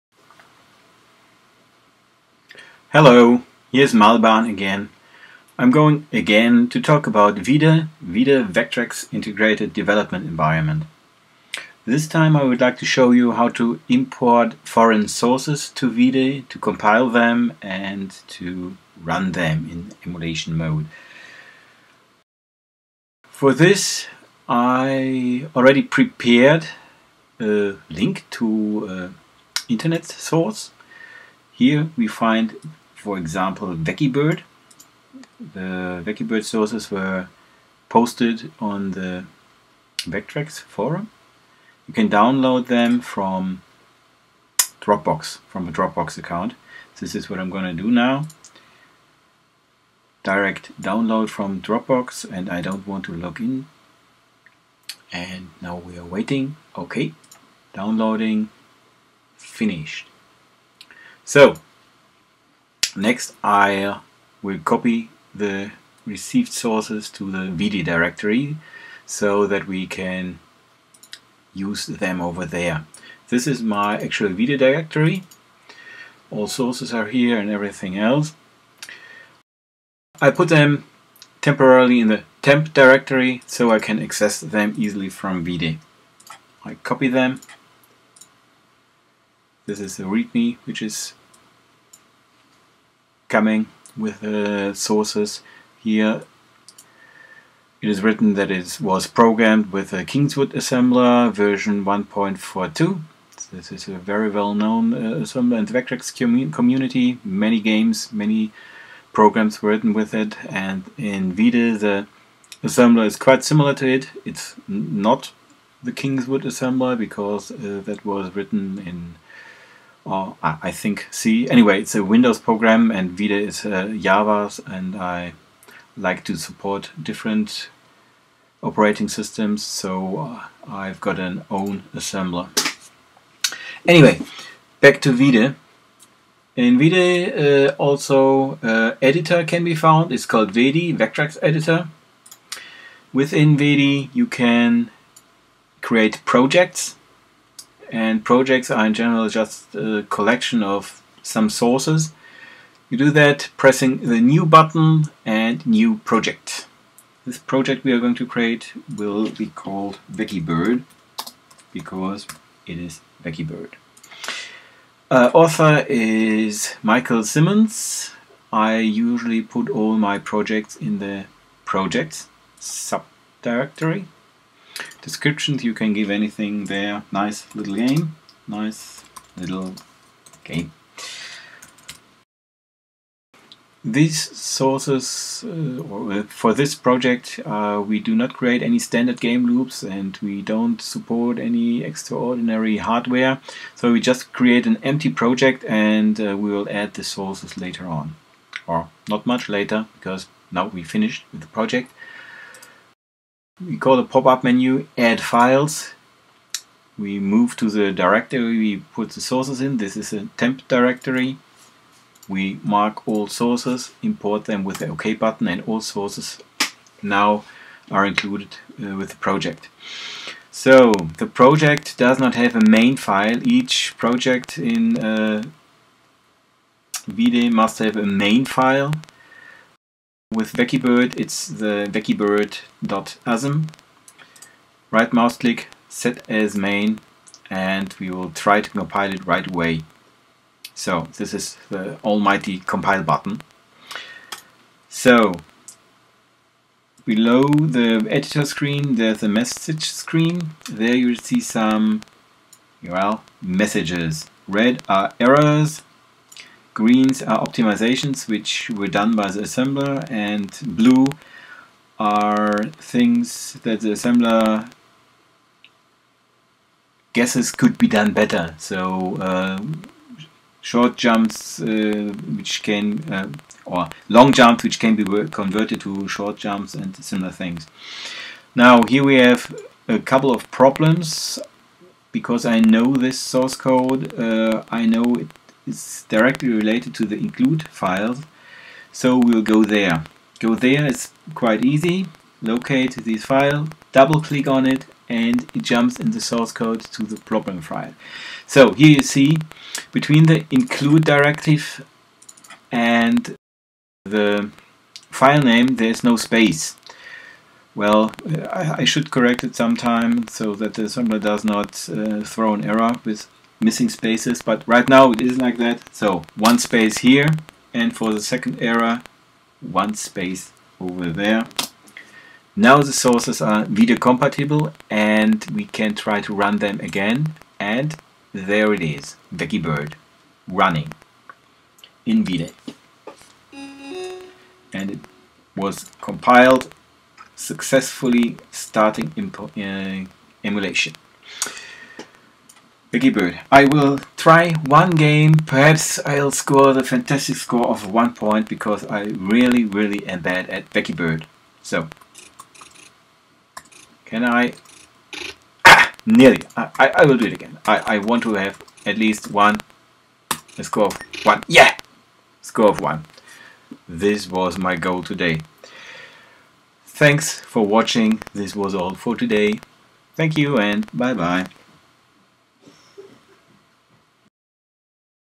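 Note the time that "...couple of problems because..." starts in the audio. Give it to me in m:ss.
4:39.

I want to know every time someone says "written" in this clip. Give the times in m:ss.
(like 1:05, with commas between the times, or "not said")
1:38, 1:49, 1:58.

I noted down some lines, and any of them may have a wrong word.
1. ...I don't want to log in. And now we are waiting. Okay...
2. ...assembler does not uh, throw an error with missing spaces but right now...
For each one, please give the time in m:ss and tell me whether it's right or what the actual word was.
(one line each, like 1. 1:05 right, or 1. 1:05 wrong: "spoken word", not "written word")
1. 0:52 right
2. 5:10 right.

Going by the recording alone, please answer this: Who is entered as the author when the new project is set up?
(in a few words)
Michael Simmons.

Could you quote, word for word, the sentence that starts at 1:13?
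This is my actual Vide directory.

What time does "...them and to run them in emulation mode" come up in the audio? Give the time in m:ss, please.
0:17.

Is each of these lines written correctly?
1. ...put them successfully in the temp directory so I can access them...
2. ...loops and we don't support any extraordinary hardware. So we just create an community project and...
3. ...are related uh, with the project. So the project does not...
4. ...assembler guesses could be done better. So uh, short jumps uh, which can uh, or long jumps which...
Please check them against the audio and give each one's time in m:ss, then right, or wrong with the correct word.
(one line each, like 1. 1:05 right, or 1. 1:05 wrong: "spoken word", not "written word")
1. 1:20 wrong: "temporarily", not "successfully"
2. 3:09 wrong: "empty", not "community"
3. 3:37 wrong: "included", not "related"
4. 4:23 right.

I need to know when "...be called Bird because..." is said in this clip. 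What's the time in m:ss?
2:39.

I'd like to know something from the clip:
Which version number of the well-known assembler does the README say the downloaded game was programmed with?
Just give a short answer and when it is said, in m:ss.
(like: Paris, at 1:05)
1.42, at 1:41.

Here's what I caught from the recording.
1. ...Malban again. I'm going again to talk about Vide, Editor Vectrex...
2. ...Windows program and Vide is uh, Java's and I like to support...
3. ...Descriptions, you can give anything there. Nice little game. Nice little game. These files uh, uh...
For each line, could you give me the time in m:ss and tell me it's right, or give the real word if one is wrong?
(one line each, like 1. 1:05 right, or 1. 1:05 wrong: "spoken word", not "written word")
1. 0:03 wrong: "Vide", not "Editor"
2. 2:02 right
3. 2:55 wrong: "sources", not "files".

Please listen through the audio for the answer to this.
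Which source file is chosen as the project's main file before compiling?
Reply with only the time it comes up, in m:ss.
3:51.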